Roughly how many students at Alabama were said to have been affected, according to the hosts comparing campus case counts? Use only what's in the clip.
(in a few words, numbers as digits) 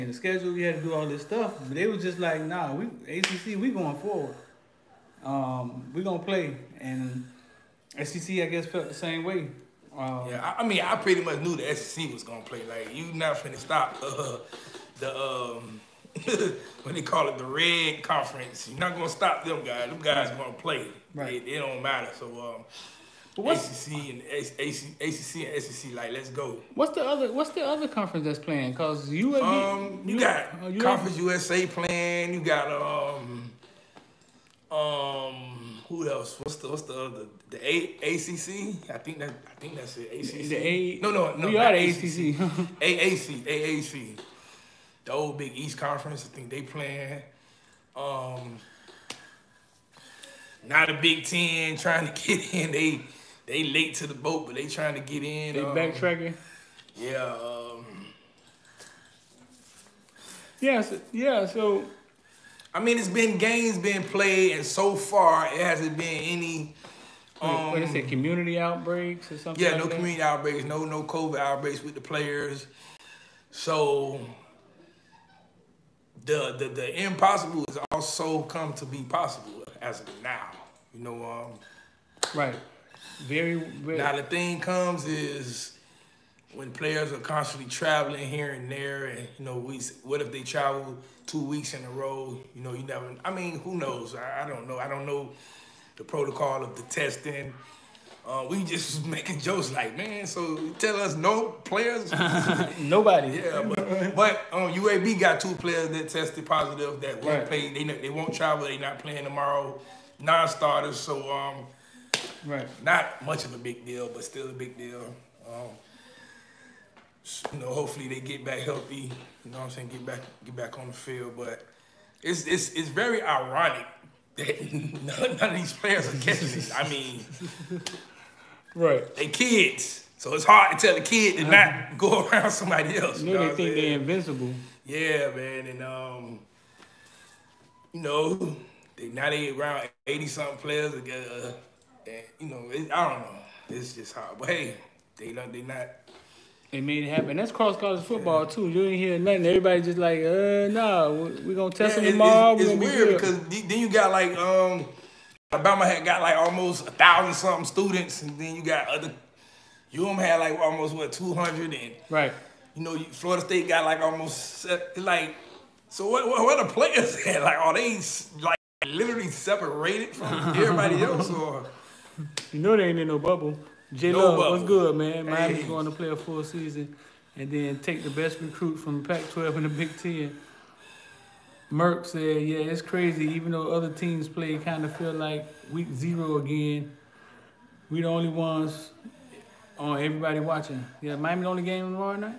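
almost a thousand.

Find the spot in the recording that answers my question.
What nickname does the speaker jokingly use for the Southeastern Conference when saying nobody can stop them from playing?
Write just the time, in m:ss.
0:17.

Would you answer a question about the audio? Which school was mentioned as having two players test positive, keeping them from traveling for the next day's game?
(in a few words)
UAB.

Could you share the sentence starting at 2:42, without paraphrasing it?
You know, Florida State got like almost like.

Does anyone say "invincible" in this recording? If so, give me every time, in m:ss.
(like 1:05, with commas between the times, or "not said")
2:13.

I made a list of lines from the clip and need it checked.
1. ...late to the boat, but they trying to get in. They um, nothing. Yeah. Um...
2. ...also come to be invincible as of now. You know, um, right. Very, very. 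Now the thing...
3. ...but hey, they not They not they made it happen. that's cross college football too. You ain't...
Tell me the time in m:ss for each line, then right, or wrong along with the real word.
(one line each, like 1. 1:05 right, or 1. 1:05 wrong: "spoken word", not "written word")
1. 0:53 wrong: "backtracking", not "nothing"
2. 1:17 wrong: "possible", not "invincible"
3. 2:24 right.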